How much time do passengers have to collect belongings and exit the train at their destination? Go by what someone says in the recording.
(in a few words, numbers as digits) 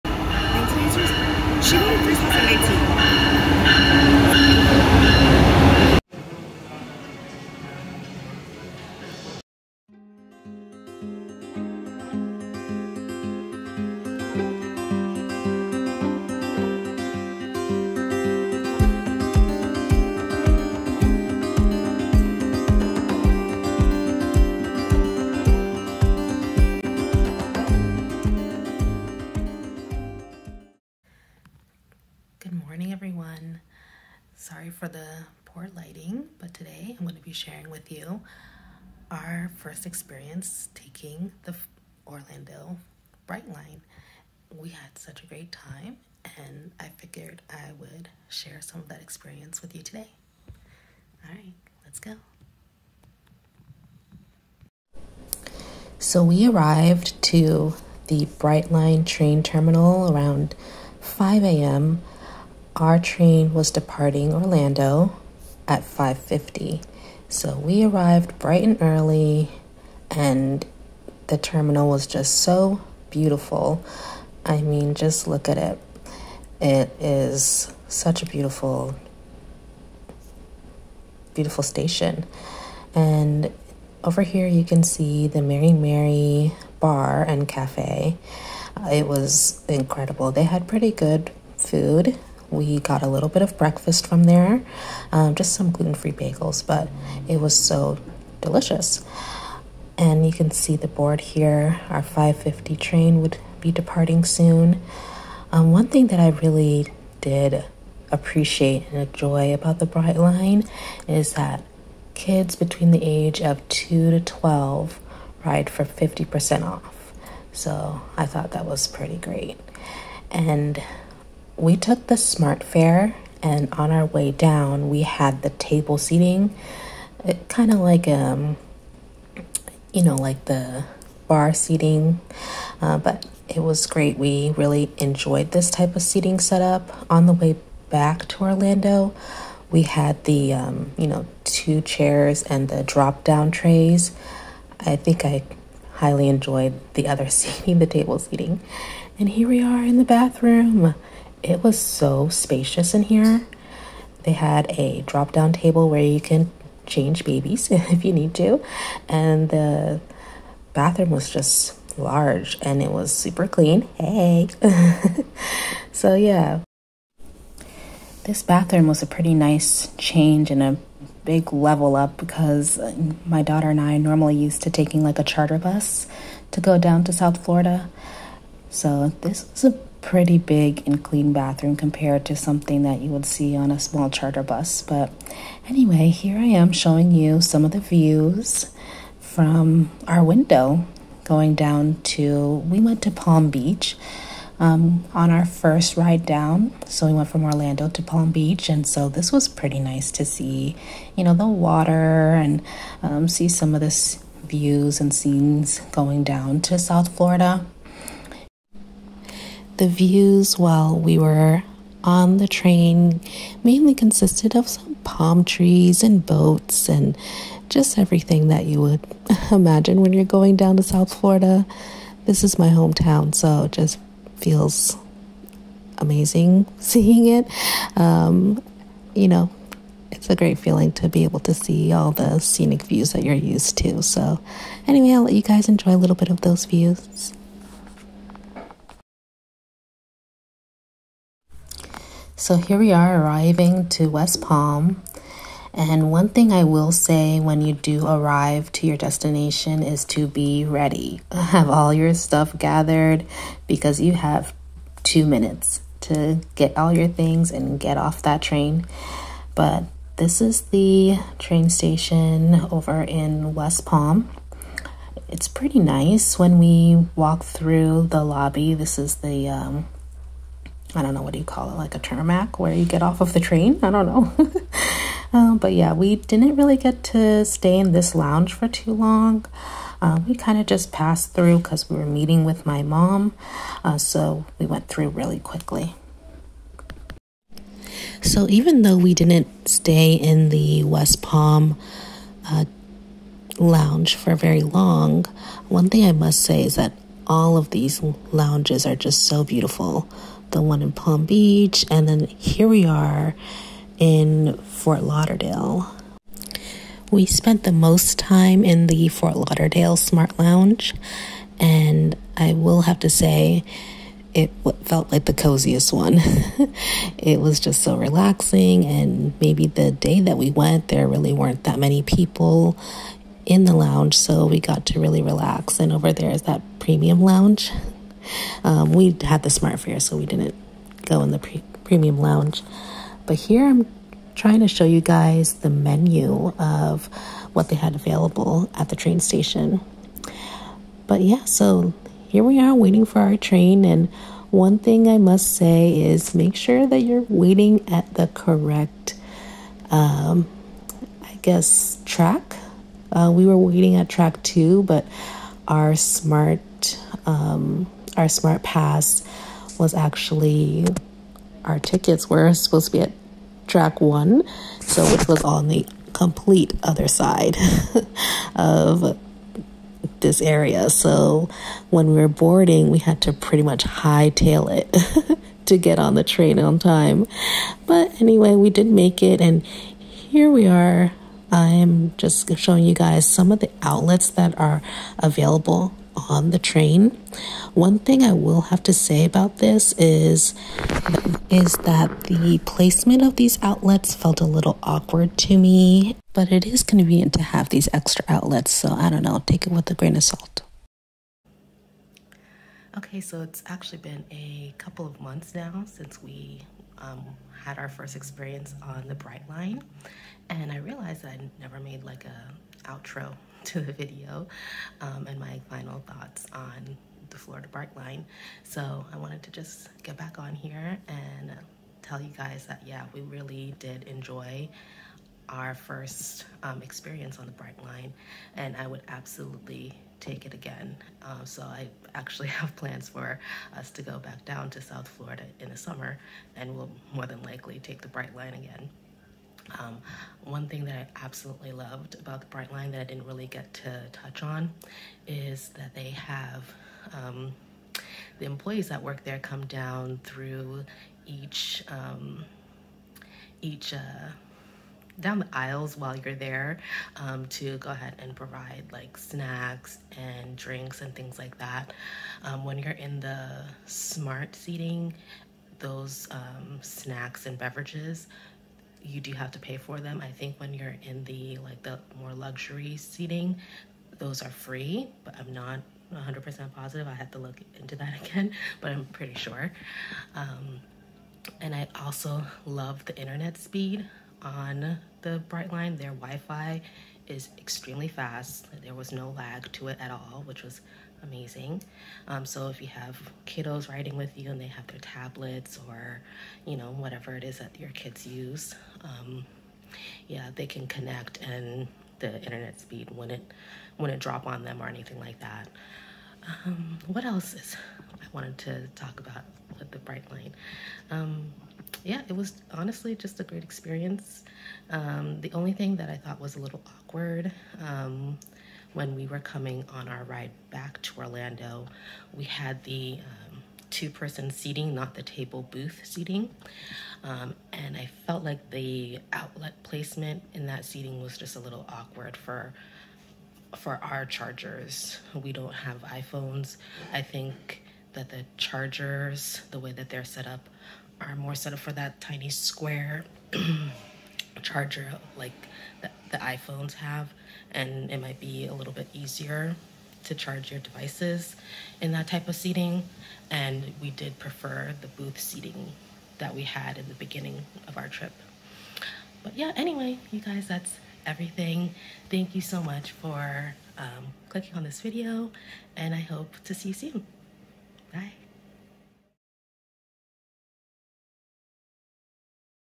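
two minutes.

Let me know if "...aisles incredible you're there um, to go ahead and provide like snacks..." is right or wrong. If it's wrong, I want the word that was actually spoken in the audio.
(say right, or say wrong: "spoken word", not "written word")
wrong: "while", not "incredible".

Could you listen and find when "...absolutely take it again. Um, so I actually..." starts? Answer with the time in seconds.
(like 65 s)
429 s.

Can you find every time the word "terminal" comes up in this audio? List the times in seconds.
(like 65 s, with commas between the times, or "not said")
59 s, 71 s.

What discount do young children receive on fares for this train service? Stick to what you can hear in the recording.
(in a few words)
50% off.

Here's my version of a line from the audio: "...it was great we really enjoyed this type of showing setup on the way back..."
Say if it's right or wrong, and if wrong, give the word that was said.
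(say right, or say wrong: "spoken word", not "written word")
wrong: "seating", not "showing".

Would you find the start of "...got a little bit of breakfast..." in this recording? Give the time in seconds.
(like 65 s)
92 s.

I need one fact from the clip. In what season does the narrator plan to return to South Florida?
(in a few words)
summer.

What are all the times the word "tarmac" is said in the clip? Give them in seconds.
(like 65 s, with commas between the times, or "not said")
271 s.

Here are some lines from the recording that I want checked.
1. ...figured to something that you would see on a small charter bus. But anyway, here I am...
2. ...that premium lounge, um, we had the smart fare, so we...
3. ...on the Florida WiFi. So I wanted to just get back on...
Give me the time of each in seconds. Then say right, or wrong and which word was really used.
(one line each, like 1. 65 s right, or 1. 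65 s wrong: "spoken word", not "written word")
1. 181 s wrong: "compared", not "figured"
2. 326 s right
3. 416 s wrong: "Brightline", not "WiFi".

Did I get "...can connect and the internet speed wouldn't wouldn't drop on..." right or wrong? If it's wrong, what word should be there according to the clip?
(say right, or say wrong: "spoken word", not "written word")
right.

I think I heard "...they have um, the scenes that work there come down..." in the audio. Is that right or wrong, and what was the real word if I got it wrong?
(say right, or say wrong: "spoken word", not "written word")
wrong: "employees", not "scenes".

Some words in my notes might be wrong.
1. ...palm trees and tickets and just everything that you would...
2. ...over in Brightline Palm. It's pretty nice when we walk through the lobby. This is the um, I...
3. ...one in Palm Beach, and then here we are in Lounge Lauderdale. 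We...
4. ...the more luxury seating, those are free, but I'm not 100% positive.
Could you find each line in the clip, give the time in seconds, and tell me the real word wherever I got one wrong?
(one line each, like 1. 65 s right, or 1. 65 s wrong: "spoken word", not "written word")
1. 215 s wrong: "boats", not "tickets"
2. 262 s wrong: "West", not "Brightline"
3. 300 s wrong: "Fort", not "Lounge"
4. 471 s right.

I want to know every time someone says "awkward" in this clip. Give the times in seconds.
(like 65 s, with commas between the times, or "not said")
394 s, 516 s, 531 s.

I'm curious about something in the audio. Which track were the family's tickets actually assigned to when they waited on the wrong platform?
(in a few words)
track one.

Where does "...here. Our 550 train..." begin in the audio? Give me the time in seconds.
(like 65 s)
101 s.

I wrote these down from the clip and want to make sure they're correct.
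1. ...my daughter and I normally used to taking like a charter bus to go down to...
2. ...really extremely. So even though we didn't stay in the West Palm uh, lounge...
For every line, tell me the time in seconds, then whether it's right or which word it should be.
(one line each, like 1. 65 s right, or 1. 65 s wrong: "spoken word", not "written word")
1. 173 s right
2. 285 s wrong: "quickly", not "extremely".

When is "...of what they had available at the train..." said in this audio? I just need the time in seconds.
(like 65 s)
336 s.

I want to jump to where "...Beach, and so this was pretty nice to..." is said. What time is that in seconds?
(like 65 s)
198 s.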